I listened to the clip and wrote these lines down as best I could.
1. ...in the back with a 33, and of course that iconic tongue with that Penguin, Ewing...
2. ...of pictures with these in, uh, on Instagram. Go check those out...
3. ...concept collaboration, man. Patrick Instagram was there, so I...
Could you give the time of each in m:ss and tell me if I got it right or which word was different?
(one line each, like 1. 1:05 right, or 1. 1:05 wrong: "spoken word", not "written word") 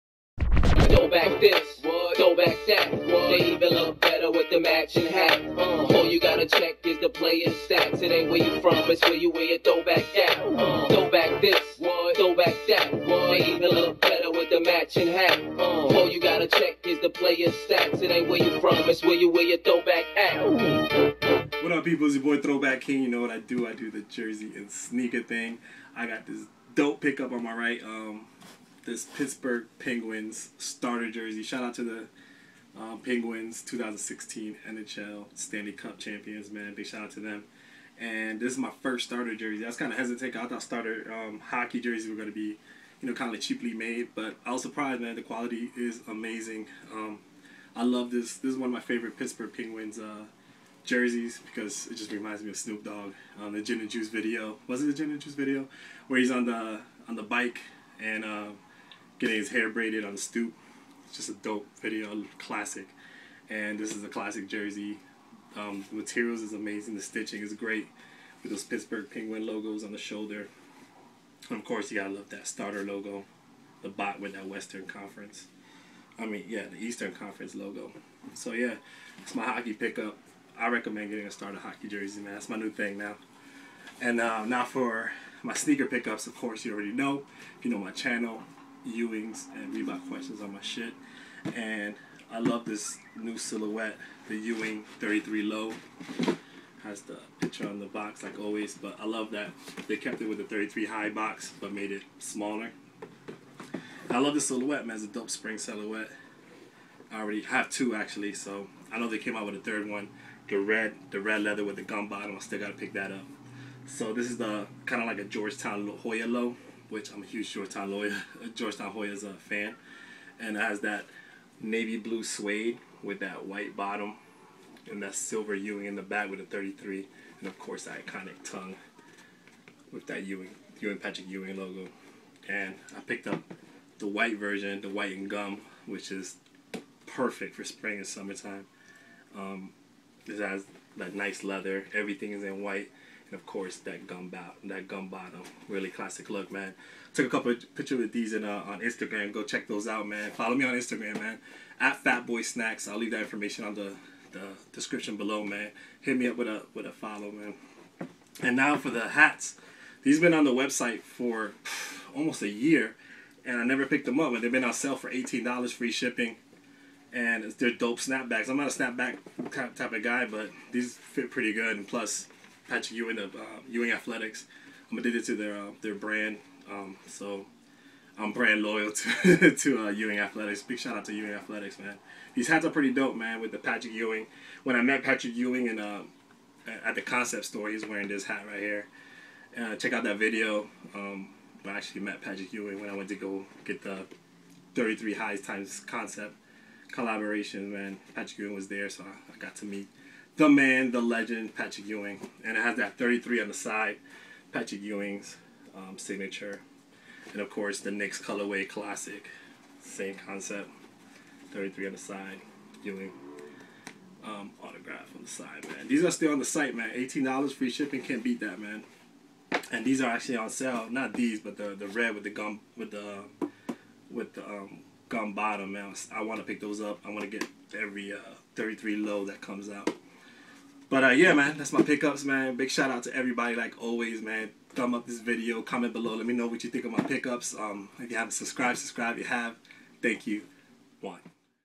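1. 2:05 wrong: "Ewing", not "Penguin"
2. 2:27 right
3. 3:15 wrong: "Ewing", not "Instagram".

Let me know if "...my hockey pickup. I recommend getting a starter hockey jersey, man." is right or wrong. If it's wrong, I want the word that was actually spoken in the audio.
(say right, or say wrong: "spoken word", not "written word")
right.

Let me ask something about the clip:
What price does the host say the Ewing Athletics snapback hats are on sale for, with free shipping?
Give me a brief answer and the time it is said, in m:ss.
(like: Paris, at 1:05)
$18, at 2:45.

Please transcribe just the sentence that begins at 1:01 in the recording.
It's just a dope video, classic.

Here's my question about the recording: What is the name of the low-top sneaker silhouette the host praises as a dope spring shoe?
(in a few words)
Ewing 33 Low.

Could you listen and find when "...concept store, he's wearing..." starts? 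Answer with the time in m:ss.
3:07.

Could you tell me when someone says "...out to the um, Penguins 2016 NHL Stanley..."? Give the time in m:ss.
0:31.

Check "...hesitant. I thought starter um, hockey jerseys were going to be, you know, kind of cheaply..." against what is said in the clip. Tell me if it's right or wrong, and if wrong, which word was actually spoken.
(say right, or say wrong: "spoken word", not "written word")
right.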